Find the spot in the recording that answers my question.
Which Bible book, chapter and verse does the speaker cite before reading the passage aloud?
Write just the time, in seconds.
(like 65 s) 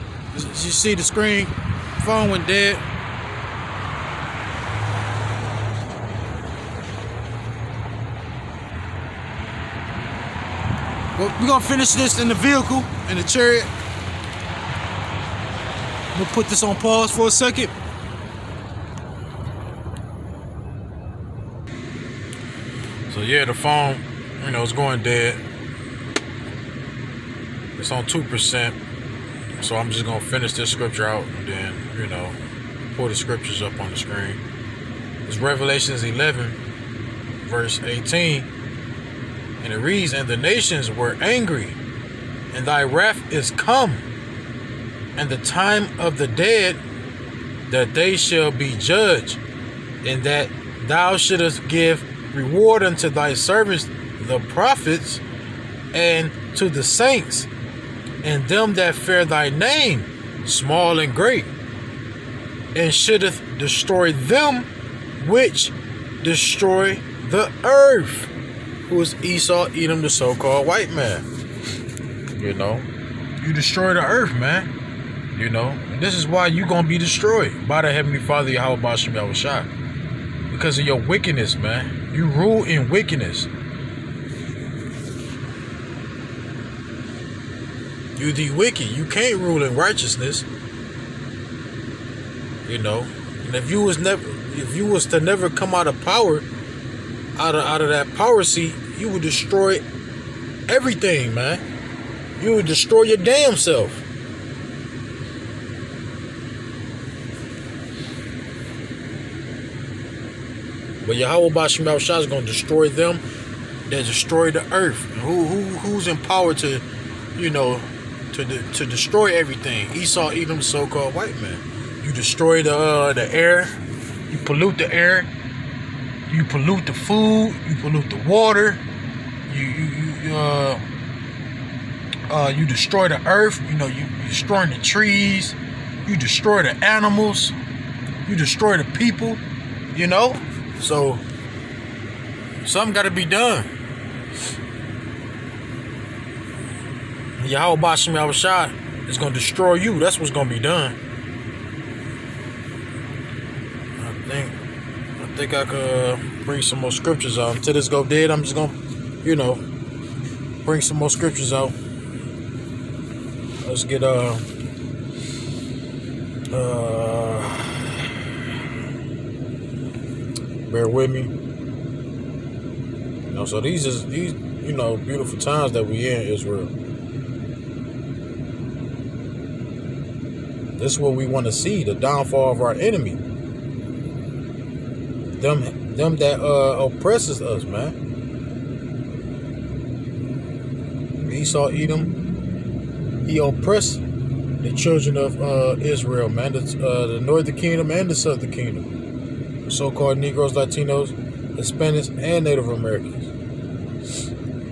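35 s.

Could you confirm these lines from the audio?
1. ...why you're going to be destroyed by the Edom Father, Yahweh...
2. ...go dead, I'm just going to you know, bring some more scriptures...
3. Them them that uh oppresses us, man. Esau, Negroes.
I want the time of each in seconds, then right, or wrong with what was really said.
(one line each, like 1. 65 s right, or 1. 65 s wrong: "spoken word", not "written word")
1. 76 s wrong: "Heavenly", not "Edom"
2. 157 s right
3. 185 s wrong: "Edom", not "Negroes".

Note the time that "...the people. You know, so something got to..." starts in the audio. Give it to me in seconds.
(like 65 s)
138 s.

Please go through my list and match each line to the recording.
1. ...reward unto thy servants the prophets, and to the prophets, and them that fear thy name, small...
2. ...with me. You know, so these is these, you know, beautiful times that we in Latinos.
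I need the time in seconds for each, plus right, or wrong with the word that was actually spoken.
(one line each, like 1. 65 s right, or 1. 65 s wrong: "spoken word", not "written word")
1. 52 s wrong: "saints", not "prophets"
2. 170 s wrong: "Israel", not "Latinos".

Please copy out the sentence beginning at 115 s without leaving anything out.
Who, who Who's in power to, you know, to de to destroy everything?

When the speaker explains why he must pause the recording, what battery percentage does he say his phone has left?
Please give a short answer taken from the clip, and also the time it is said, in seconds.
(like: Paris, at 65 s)
2%, at 28 s.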